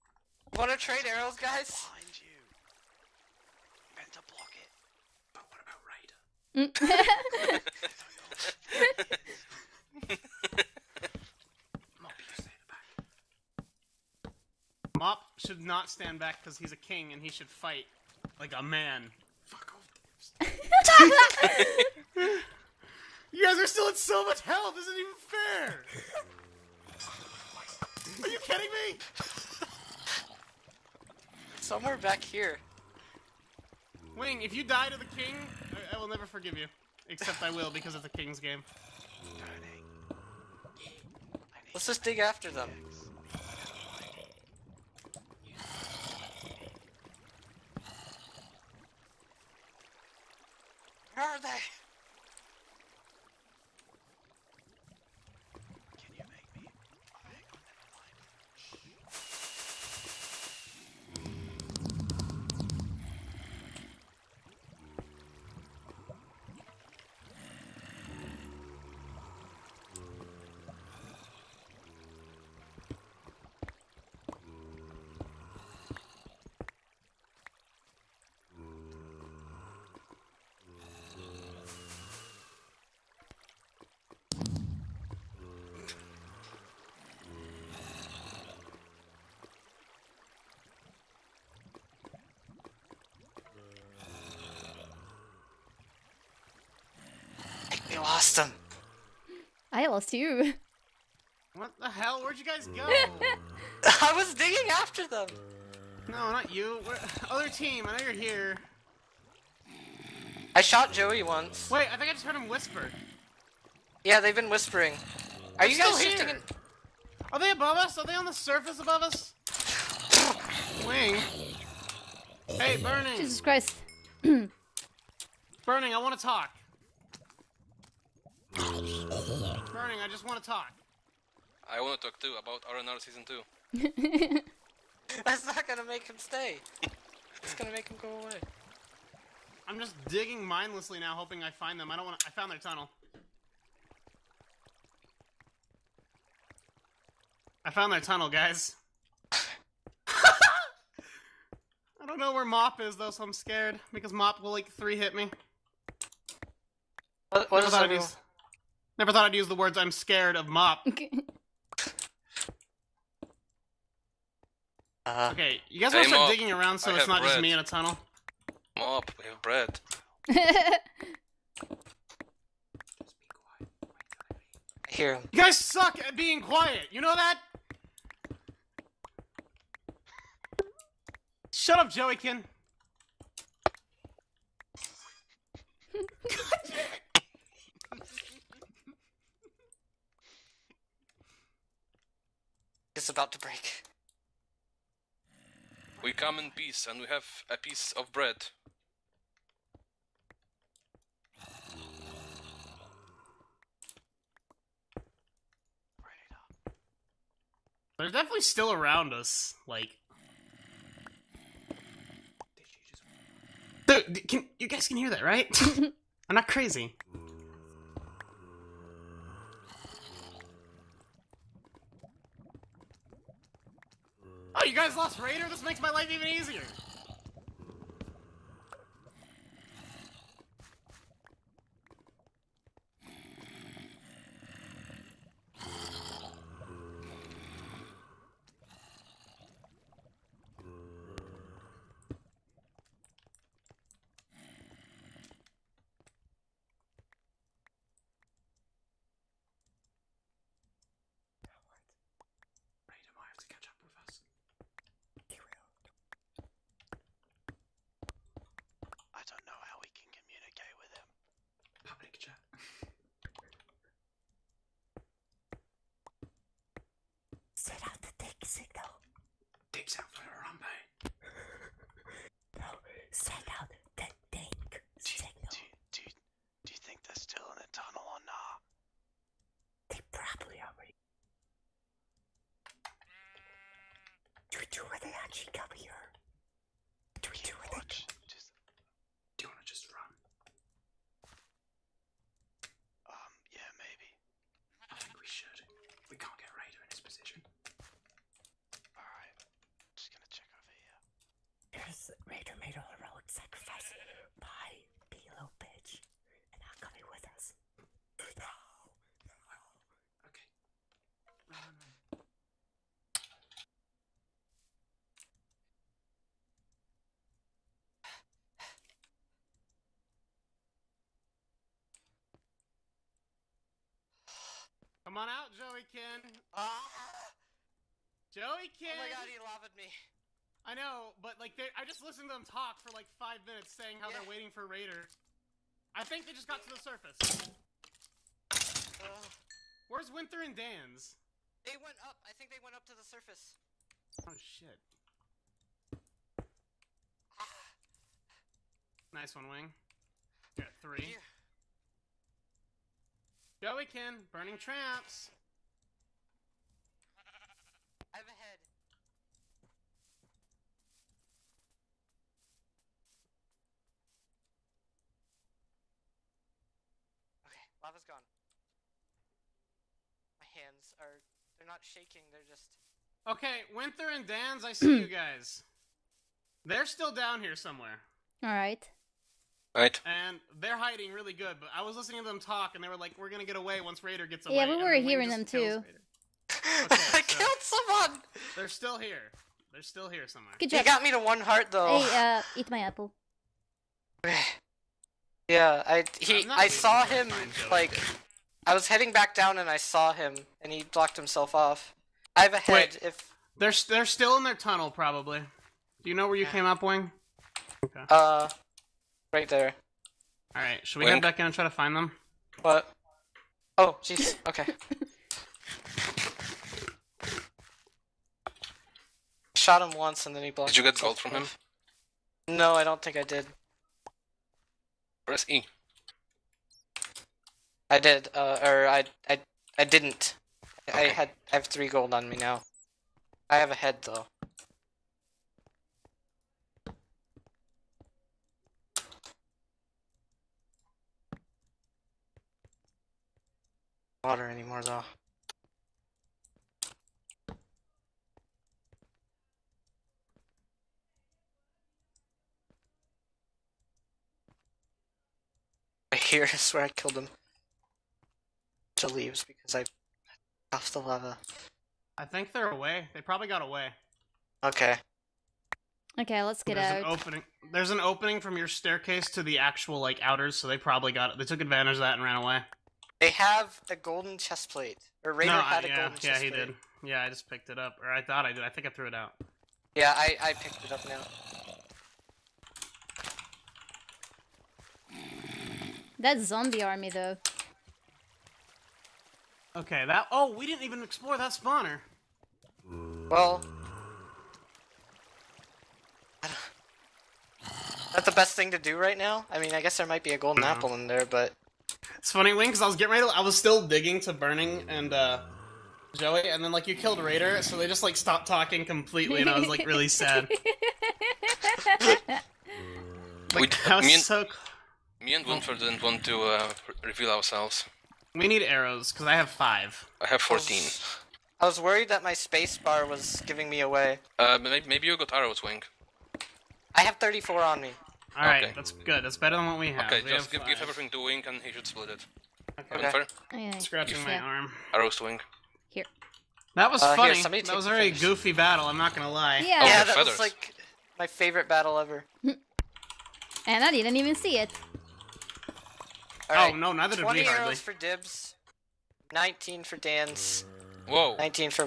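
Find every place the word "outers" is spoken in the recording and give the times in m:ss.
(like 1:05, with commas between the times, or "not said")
7:50.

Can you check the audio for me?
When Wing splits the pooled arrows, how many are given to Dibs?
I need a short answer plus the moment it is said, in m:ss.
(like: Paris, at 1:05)
20, at 9:07.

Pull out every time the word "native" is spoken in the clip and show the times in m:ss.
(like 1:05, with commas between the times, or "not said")
not said.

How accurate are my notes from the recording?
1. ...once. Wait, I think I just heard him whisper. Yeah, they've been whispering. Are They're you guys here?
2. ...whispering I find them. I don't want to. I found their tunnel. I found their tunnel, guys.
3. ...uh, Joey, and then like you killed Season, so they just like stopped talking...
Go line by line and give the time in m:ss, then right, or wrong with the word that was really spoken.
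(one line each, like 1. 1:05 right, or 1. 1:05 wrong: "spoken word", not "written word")
1. 1:51 right
2. 2:21 wrong: "hoping", not "whispering"
3. 8:25 wrong: "Raider", not "Season".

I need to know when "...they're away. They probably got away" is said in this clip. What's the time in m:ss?
7:42.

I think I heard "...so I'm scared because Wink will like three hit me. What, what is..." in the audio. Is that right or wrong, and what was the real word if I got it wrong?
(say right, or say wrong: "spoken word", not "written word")
wrong: "Mop", not "Wink".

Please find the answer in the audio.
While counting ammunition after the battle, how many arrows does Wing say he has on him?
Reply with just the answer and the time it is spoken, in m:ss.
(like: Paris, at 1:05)
34, at 8:46.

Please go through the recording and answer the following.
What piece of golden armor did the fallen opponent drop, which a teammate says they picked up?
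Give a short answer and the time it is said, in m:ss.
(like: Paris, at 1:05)
golden chest plate, at 7:53.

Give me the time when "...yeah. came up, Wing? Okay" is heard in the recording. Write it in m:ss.
6:46.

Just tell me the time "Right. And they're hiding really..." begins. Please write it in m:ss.
6:19.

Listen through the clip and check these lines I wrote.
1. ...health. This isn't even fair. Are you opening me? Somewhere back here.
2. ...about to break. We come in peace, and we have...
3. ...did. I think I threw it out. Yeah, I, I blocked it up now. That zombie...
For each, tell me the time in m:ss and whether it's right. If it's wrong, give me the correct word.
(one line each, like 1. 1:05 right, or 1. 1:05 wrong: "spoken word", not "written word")
1. 0:24 wrong: "kidding", not "opening"
2. 3:13 right
3. 7:58 wrong: "picked", not "blocked".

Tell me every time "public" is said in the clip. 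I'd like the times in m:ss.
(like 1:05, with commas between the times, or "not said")
4:21.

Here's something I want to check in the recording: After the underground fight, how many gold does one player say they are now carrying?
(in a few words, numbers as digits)
3.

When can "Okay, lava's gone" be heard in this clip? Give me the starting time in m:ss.
6:07.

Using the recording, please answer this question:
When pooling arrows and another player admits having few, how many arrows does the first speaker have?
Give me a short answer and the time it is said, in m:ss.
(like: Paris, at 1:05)
5, at 8:39.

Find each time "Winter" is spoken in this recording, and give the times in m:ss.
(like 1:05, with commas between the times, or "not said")
5:40, 6:13.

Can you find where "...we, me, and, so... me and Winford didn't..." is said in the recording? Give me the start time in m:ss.
8:33.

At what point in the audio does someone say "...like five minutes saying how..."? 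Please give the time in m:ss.
5:32.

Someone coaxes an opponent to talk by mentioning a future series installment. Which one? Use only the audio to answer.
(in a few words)
Season 2.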